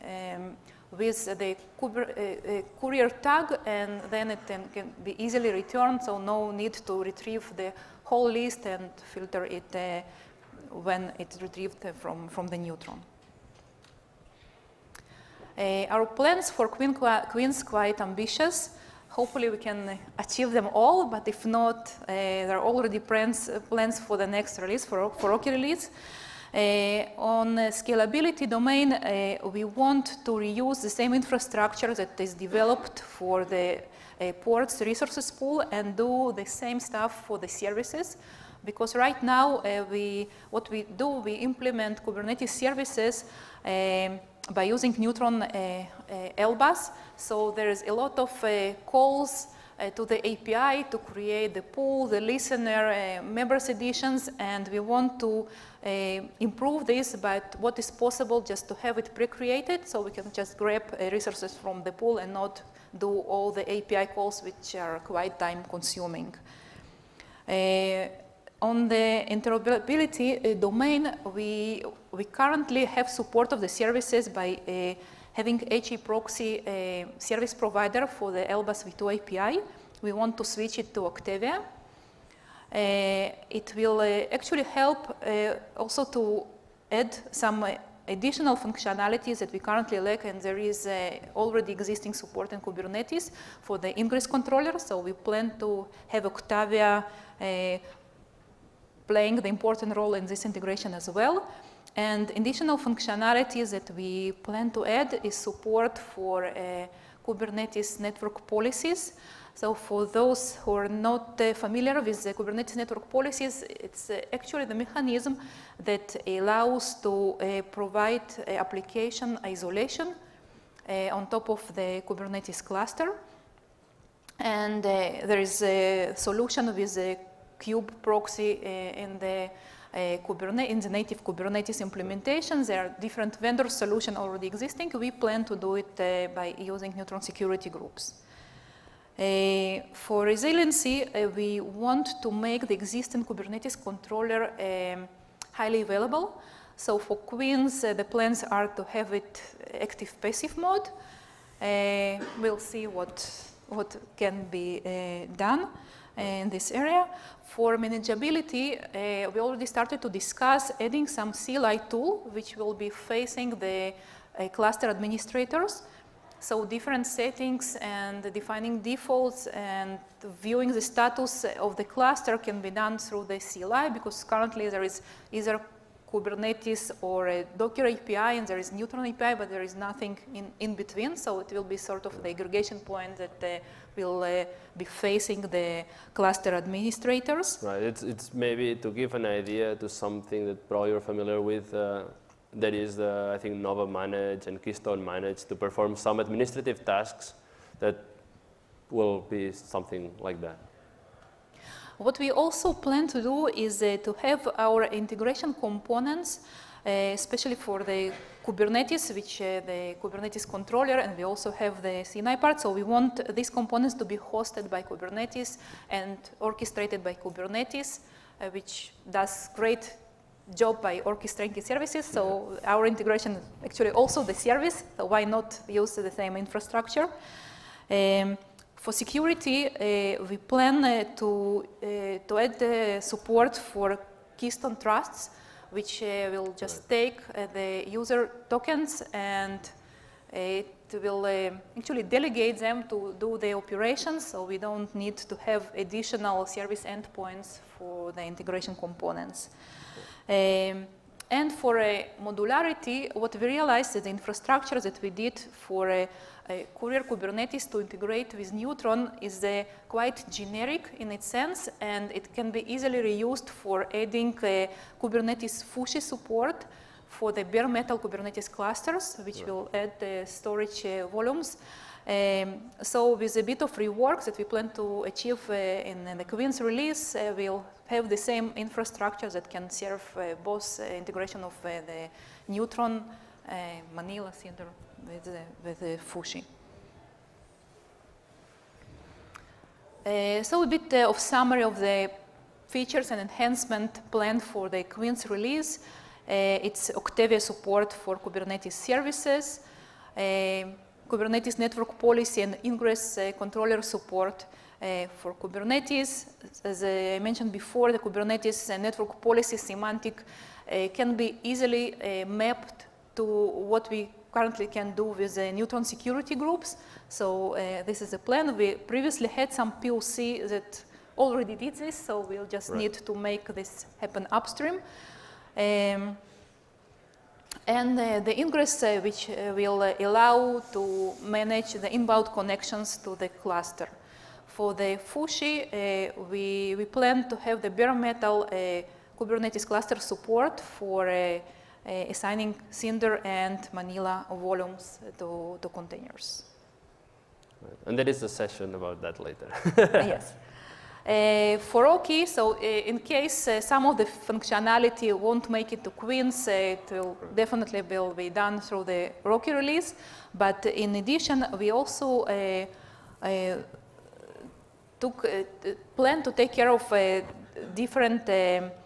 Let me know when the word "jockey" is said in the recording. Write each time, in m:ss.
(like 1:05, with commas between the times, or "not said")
not said.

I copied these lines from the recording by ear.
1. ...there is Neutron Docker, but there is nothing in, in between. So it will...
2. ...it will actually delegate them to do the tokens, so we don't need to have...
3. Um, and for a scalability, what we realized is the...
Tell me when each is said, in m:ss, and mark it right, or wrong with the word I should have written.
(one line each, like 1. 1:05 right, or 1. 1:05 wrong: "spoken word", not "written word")
1. 2:58 wrong: "API", not "Docker"
2. 4:00 wrong: "operations", not "tokens"
3. 4:10 wrong: "modularity", not "scalability".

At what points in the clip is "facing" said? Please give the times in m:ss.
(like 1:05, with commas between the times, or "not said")
2:42, 3:04.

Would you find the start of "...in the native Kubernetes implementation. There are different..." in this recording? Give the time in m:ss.
2:10.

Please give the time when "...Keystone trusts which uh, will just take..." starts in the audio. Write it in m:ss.
3:54.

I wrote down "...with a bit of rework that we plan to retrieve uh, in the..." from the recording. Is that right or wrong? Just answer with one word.
wrong.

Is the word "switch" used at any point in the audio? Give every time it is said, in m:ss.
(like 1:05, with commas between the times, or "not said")
1:20.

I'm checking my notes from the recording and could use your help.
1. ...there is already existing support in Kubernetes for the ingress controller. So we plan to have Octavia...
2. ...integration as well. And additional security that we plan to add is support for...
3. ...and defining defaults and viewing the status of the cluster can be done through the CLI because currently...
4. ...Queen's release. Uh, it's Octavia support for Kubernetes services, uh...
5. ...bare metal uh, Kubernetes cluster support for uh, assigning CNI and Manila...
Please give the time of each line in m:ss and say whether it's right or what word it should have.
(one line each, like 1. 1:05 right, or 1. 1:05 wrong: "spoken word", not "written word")
1. 1:30 right
2. 1:40 wrong: "functionality", not "security"
3. 2:47 right
4. 4:54 right
5. 5:37 wrong: "Cinder", not "CNI".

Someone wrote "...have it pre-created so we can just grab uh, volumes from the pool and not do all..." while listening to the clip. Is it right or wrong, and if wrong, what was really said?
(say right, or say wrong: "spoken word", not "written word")
wrong: "resources", not "volumes".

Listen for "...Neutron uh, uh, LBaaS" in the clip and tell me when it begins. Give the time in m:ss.
0:44.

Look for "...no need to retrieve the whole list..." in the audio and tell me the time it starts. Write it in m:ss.
0:06.